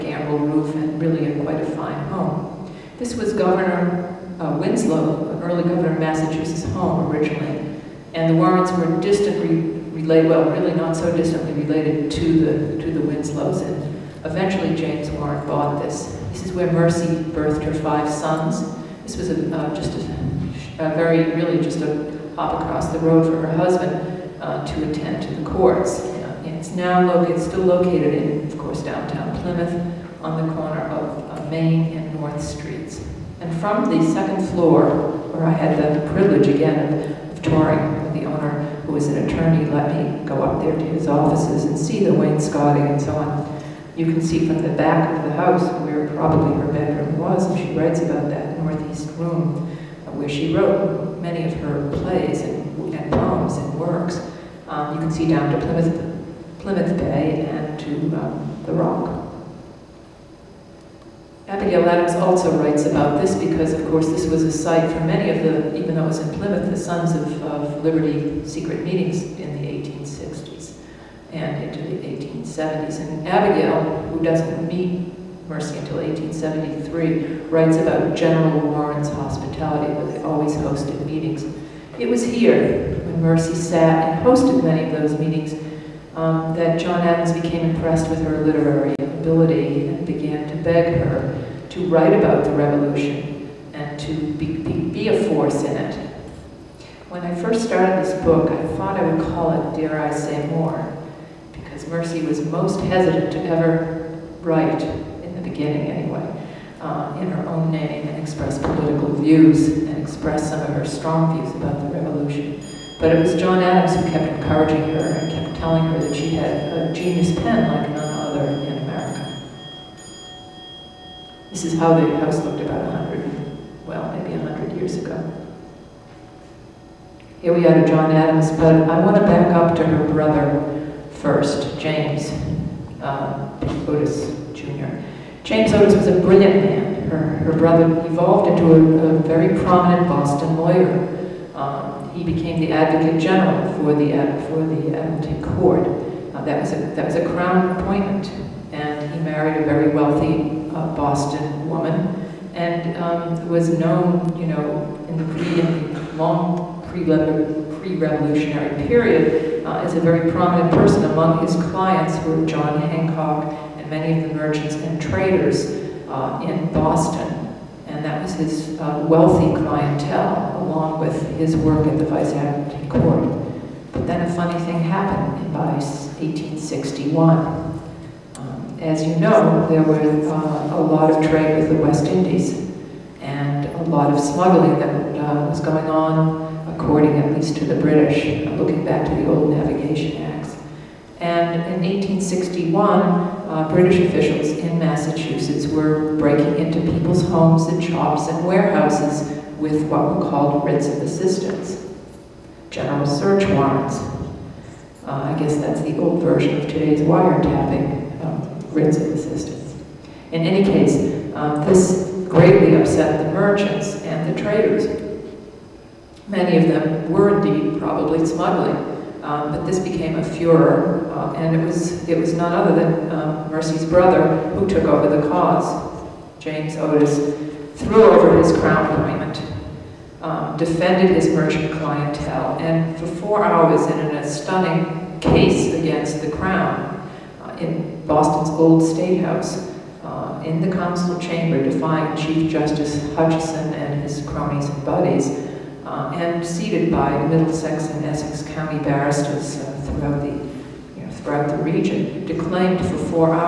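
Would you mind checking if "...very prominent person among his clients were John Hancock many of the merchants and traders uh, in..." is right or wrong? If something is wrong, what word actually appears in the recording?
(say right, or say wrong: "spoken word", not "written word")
right.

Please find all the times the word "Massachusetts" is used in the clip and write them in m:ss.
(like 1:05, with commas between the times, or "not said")
0:05, 3:14.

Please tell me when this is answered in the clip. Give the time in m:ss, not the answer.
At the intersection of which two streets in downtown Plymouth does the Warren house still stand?
0:31.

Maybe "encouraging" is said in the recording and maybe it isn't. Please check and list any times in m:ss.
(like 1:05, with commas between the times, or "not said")
1:54.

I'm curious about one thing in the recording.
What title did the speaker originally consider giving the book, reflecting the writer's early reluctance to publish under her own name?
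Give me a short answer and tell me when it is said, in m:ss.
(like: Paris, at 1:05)
Dare I Say More, at 1:39.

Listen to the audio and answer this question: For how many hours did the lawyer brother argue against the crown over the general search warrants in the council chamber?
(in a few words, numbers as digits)
4.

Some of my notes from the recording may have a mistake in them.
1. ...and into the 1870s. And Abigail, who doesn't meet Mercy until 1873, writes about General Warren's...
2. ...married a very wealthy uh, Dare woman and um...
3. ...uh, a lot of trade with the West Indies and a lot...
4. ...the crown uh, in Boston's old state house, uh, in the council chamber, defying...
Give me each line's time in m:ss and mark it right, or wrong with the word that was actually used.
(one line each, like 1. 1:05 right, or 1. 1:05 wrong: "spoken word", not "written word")
1. 1:11 right
2. 2:29 wrong: "Boston", not "Dare"
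3. 3:00 right
4. 3:56 right.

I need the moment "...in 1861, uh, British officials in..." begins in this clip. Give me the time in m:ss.
3:11.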